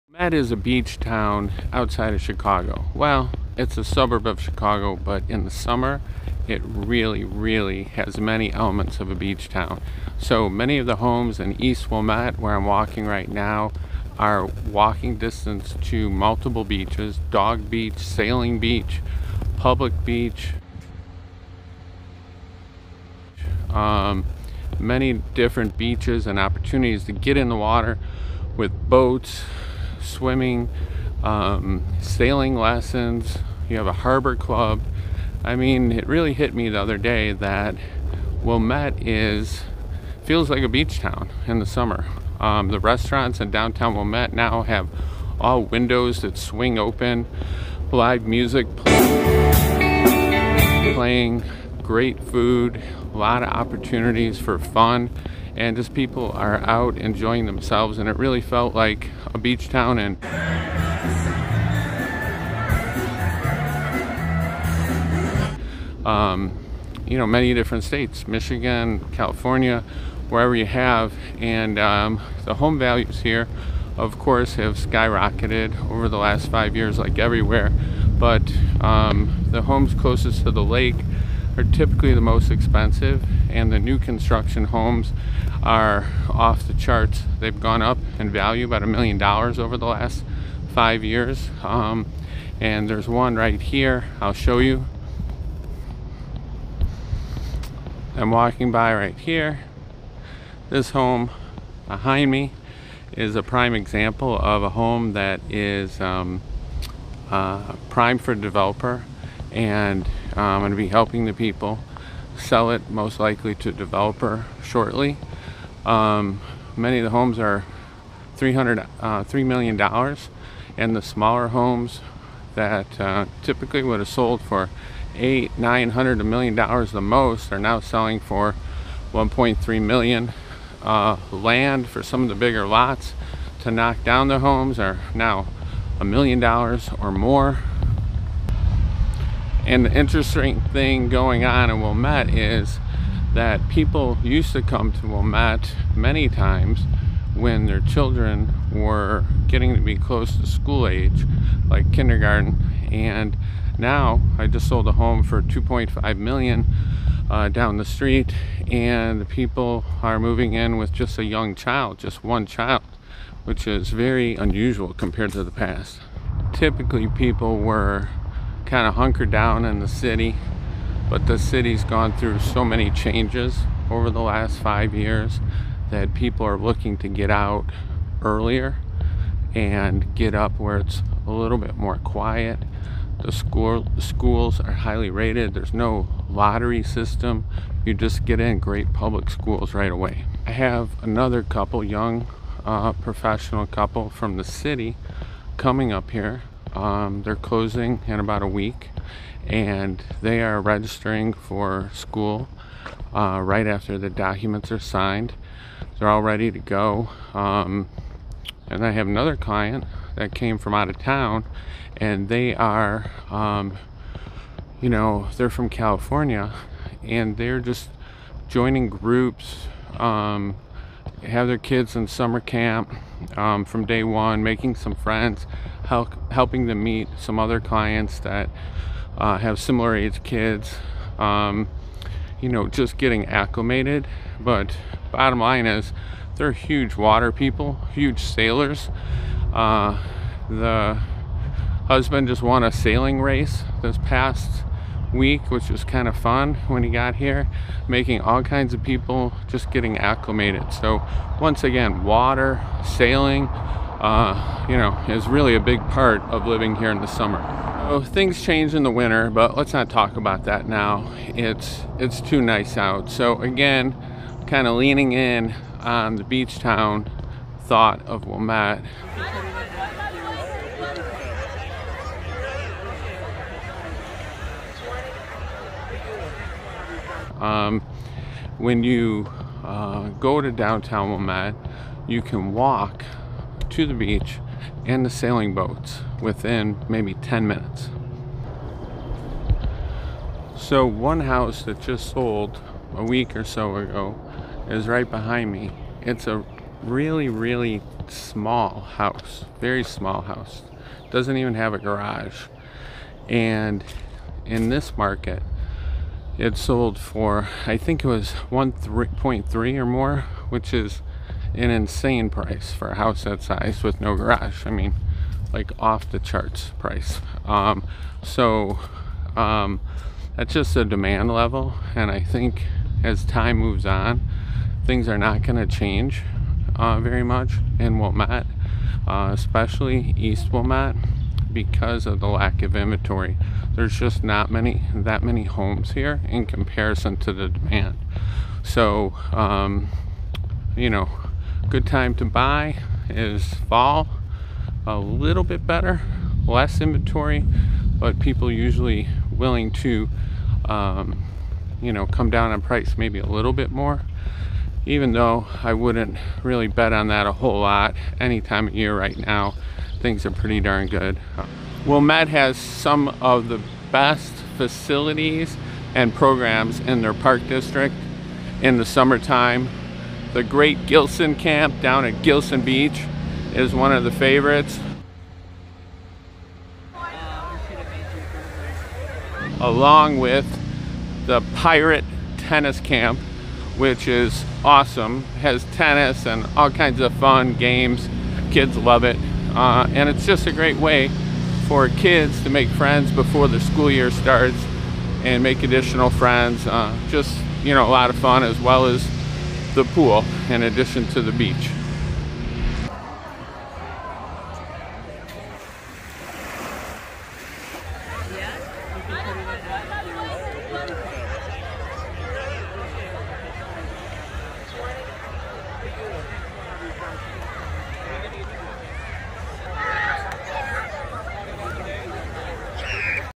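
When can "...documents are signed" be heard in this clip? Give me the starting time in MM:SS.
03:24.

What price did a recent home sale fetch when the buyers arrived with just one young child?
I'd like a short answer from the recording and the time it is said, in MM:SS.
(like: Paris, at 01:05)
$2.5 million, at 02:35.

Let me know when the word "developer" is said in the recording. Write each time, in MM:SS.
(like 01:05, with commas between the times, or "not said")
01:48, 01:53.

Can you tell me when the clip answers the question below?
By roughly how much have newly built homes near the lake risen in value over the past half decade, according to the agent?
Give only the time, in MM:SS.
01:28.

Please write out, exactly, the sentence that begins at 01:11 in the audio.
And um, the home values here, of course, have skyrocketed over the last five years, like everywhere.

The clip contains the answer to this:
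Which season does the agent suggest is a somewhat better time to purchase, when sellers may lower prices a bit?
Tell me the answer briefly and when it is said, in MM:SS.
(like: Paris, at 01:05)
Fall, at 05:43.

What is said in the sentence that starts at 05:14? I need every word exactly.
I mean, like off the charts price.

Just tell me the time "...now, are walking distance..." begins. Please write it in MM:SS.
00:13.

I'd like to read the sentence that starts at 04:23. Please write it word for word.
So again, kind of leaning in on the beach town thought of Wilmette.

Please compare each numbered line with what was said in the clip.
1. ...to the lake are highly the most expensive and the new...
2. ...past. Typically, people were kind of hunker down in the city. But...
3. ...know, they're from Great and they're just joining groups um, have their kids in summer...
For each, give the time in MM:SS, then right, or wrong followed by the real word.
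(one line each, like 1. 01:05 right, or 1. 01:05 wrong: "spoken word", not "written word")
1. 01:20 wrong: "typically", not "highly"
2. 02:45 right
3. 03:34 wrong: "California", not "Great".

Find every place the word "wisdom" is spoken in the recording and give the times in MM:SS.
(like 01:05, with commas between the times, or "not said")
not said.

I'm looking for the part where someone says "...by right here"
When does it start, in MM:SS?
01:38.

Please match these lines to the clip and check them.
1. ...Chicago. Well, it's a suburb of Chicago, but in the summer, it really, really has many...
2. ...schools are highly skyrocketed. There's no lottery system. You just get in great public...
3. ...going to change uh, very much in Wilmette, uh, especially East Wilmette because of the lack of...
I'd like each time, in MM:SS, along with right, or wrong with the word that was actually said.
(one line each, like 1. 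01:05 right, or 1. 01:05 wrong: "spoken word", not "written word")
1. 00:02 right
2. 03:03 wrong: "rated", not "skyrocketed"
3. 05:25 right.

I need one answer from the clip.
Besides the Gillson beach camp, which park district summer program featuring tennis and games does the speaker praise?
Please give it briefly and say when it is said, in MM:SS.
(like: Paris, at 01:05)
Pirate Tennis Camp, at 06:21.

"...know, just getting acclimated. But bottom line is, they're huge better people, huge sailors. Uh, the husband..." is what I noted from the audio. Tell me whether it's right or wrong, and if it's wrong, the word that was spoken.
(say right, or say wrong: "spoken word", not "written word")
wrong: "water", not "better".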